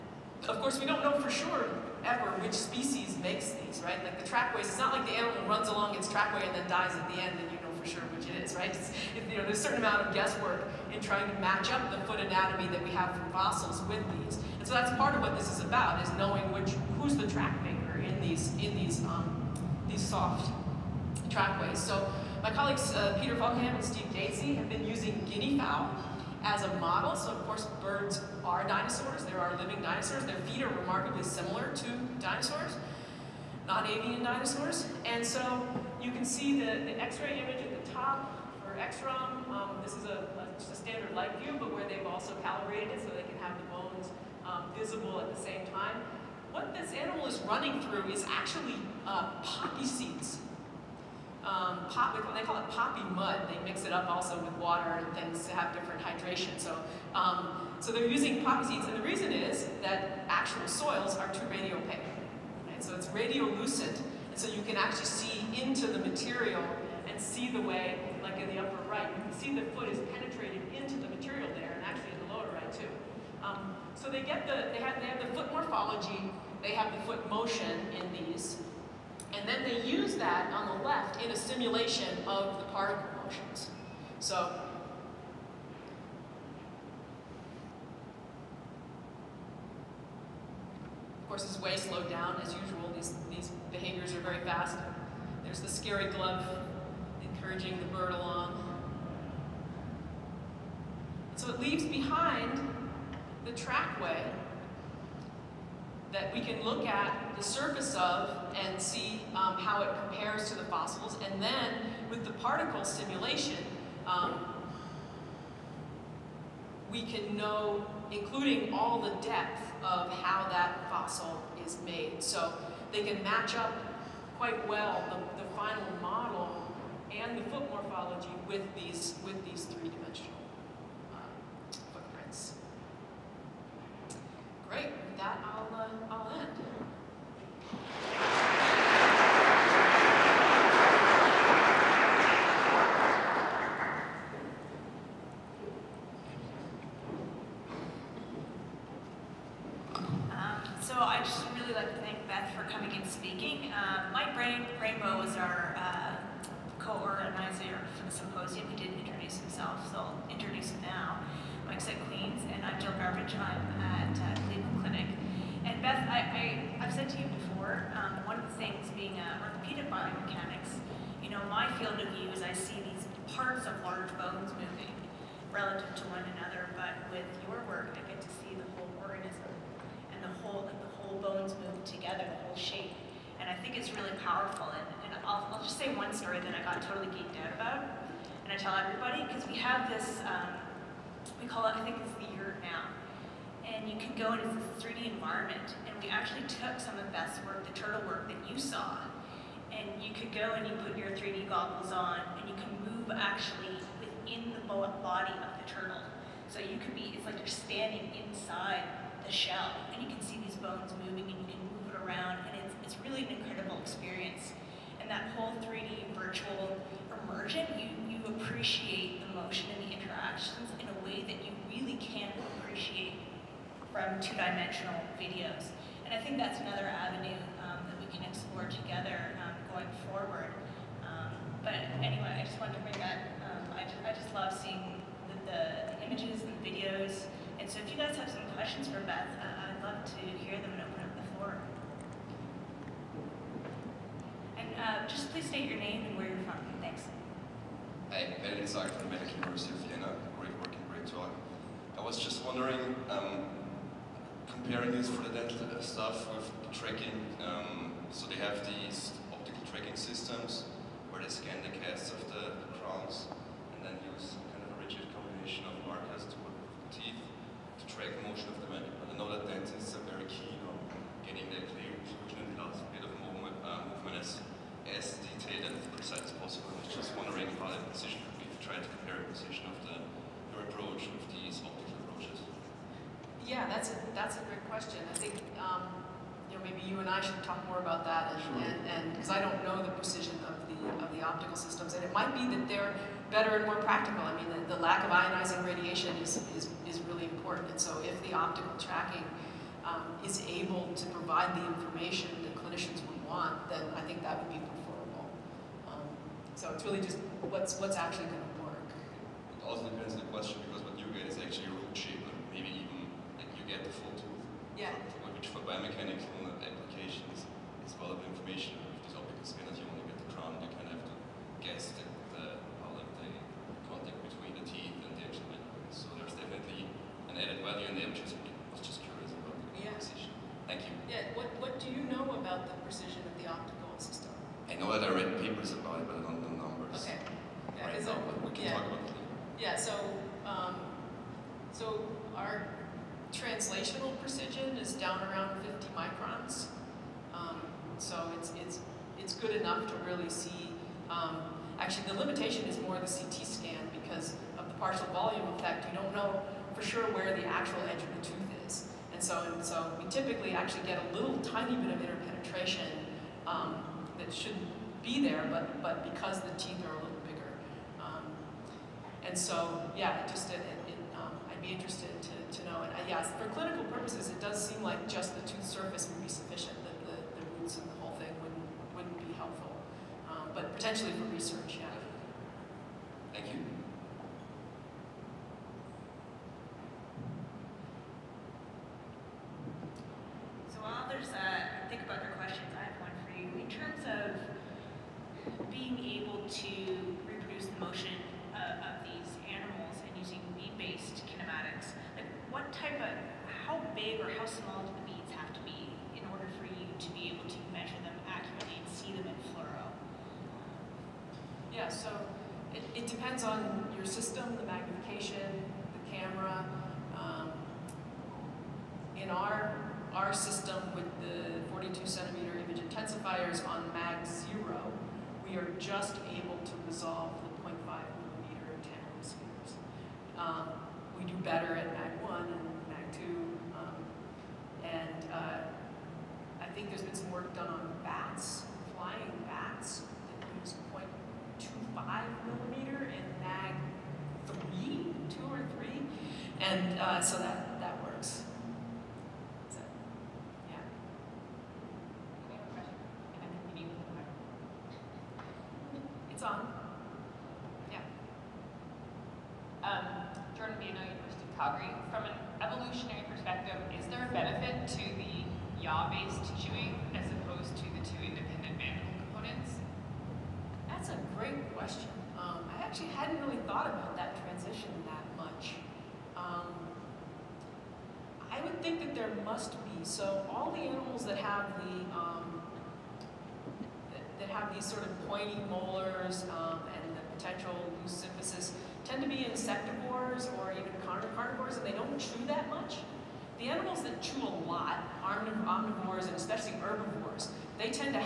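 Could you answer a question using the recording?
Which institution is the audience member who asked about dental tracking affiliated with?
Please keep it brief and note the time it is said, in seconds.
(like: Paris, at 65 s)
Medical University of Vienna, at 249 s.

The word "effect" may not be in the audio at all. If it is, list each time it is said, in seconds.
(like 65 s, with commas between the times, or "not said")
355 s.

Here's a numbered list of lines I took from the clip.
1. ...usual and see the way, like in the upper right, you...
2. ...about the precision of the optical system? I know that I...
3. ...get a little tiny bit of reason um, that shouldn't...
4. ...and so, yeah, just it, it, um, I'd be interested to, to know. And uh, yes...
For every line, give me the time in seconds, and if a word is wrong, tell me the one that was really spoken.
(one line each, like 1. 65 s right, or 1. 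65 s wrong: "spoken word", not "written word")
1. 65 s wrong: "material", not "usual"
2. 332 s right
3. 360 s wrong: "interpenetration", not "reason"
4. 369 s right.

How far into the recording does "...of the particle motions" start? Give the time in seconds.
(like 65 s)
82 s.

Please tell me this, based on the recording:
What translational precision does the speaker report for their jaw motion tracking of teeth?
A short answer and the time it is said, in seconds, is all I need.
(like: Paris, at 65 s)
50 microns, at 345 s.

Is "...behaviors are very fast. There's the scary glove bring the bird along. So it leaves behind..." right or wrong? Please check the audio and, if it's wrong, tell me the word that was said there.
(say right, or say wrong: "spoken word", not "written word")
wrong: "encouraging", not "bring".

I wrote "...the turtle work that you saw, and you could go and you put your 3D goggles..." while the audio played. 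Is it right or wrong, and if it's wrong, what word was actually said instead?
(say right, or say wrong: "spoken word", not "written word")
right.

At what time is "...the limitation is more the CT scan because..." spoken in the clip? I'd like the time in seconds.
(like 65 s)
352 s.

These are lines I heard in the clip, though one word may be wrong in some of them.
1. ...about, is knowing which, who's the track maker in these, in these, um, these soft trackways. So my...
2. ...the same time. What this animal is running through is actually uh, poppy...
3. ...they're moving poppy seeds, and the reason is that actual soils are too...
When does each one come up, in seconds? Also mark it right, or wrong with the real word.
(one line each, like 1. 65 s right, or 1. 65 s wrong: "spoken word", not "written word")
1. 15 s right
2. 45 s right
3. 57 s wrong: "using", not "moving".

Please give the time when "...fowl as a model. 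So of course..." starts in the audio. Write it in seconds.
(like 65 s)
25 s.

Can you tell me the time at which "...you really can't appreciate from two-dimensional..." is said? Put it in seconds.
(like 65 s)
221 s.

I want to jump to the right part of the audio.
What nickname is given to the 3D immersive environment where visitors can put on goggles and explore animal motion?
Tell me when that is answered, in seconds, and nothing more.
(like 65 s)
192 s.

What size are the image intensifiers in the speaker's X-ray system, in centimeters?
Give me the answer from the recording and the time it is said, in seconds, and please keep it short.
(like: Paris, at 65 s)
42 centimeters, at 421 s.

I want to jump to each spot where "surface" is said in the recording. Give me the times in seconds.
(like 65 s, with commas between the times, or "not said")
107 s, 375 s.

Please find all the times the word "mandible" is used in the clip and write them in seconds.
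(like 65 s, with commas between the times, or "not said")
268 s, 325 s.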